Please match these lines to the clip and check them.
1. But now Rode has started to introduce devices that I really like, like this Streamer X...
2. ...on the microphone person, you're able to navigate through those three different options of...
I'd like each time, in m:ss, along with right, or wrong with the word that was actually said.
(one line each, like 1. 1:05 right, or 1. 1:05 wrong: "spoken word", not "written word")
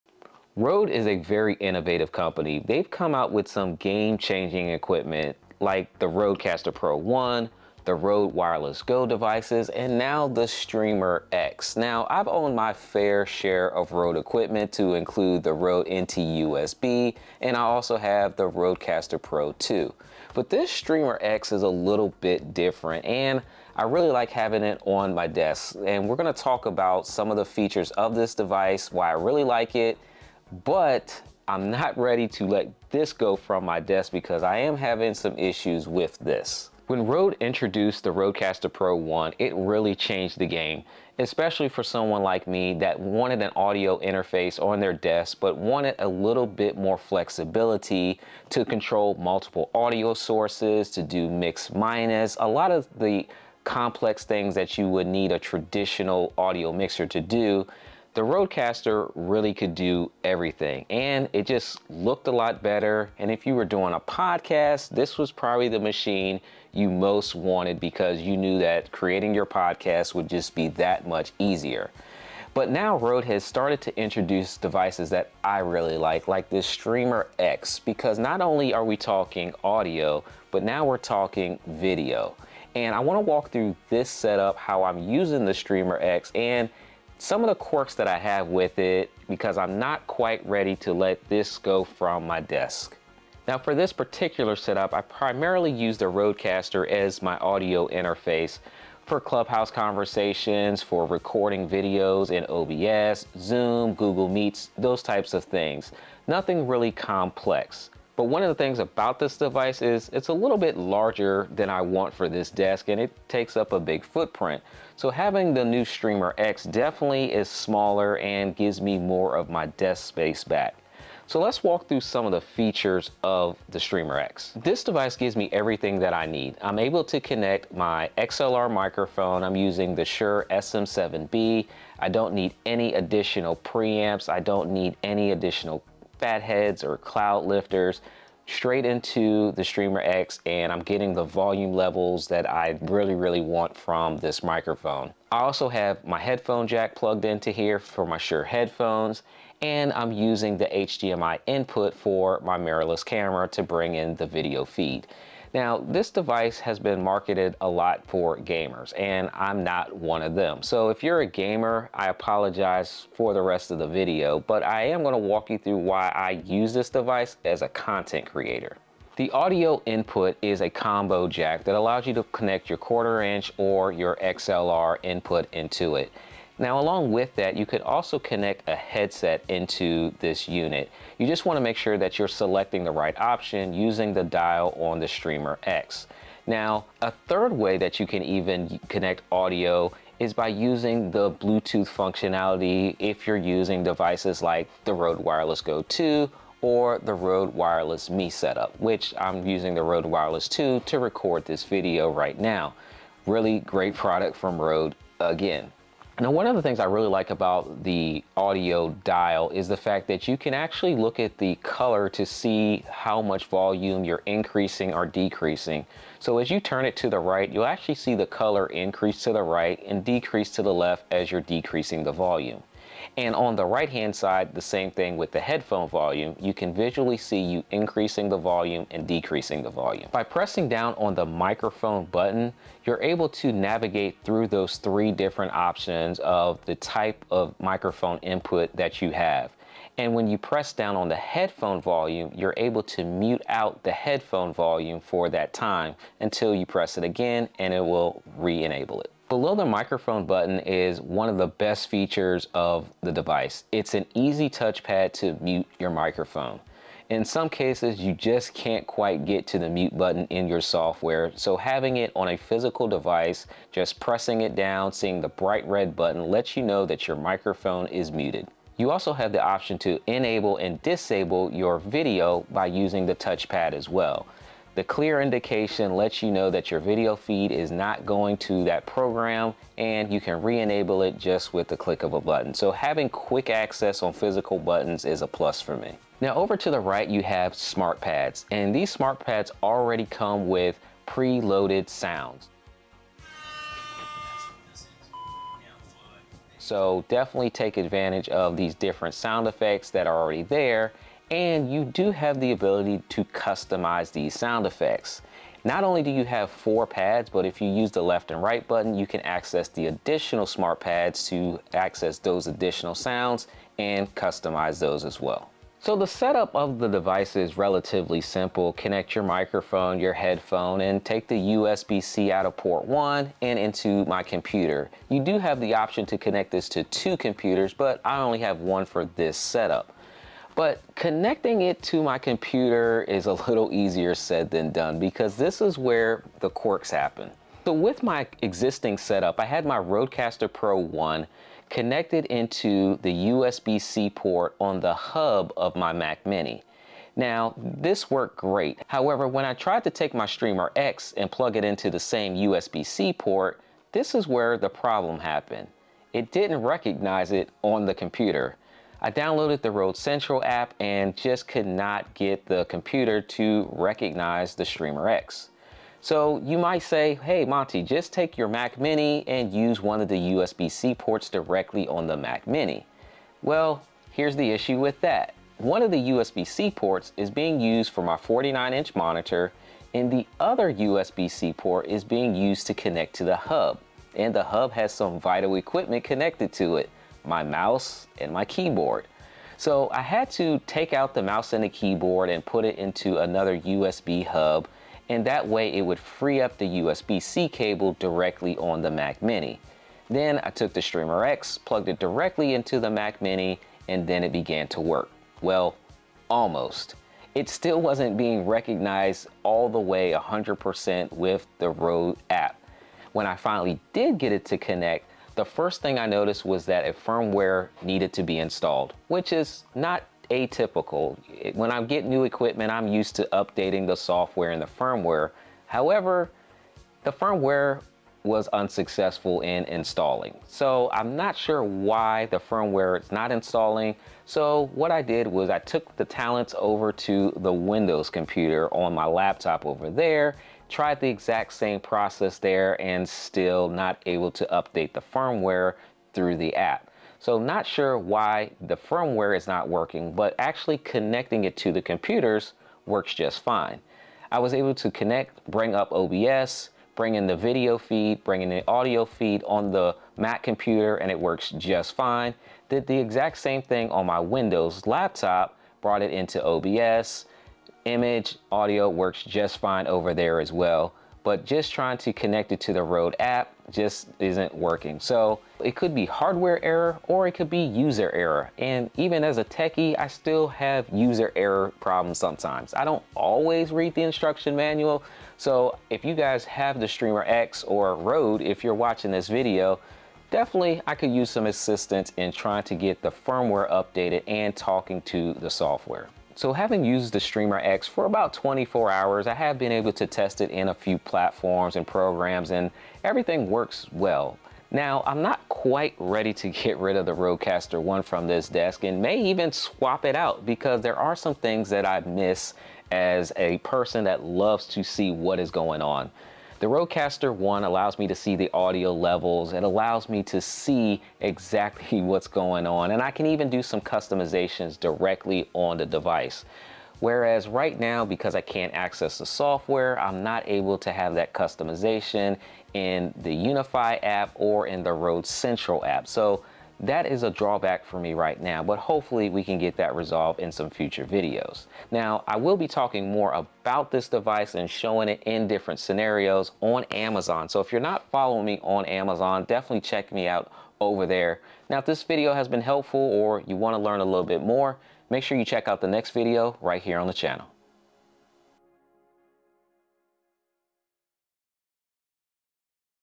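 1. 1:12 right
2. 3:50 wrong: "button", not "person".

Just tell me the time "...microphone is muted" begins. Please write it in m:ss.
4:27.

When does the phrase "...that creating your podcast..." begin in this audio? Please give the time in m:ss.
1:08.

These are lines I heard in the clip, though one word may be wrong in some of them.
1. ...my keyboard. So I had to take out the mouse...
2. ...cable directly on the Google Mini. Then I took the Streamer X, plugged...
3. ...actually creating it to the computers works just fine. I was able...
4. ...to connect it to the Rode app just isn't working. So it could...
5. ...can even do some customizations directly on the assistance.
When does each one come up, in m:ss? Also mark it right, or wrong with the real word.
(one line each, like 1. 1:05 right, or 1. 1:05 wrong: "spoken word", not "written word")
1. 6:28 right
2. 6:37 wrong: "Mac", not "Google"
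3. 7:30 wrong: "connecting", not "creating"
4. 7:51 right
5. 8:43 wrong: "device", not "assistance".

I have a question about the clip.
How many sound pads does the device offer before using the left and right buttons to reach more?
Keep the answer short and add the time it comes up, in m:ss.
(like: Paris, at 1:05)
4, at 5:06.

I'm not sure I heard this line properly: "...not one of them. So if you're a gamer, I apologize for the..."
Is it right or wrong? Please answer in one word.
right.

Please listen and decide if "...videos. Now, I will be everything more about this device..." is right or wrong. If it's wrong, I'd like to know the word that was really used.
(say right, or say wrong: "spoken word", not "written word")
wrong: "talking", not "everything".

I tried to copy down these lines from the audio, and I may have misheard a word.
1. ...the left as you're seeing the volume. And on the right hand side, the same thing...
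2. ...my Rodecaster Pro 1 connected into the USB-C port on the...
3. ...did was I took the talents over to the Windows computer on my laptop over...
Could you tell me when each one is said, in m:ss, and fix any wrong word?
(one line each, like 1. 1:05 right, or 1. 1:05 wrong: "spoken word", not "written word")
1. 3:40 wrong: "decreasing", not "seeing"
2. 5:39 right
3. 7:15 right.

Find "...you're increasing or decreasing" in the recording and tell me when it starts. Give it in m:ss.
3:34.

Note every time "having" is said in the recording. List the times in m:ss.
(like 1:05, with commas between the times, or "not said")
0:24, 0:34, 1:55, 4:21, 4:42, 8:16.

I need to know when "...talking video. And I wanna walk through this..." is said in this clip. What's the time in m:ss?
1:20.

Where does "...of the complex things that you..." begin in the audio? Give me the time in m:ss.
0:52.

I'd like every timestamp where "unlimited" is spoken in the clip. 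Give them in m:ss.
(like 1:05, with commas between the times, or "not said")
not said.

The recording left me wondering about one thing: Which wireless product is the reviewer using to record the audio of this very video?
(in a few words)
Rode Wireless 2.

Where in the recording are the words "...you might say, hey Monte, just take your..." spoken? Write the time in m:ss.
6:06.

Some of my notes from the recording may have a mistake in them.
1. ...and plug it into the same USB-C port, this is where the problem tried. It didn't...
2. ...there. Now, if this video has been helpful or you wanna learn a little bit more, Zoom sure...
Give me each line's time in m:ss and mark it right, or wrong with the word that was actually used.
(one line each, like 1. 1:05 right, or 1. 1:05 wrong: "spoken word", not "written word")
1. 5:51 wrong: "happened", not "tried"
2. 9:11 wrong: "Make", not "Zoom".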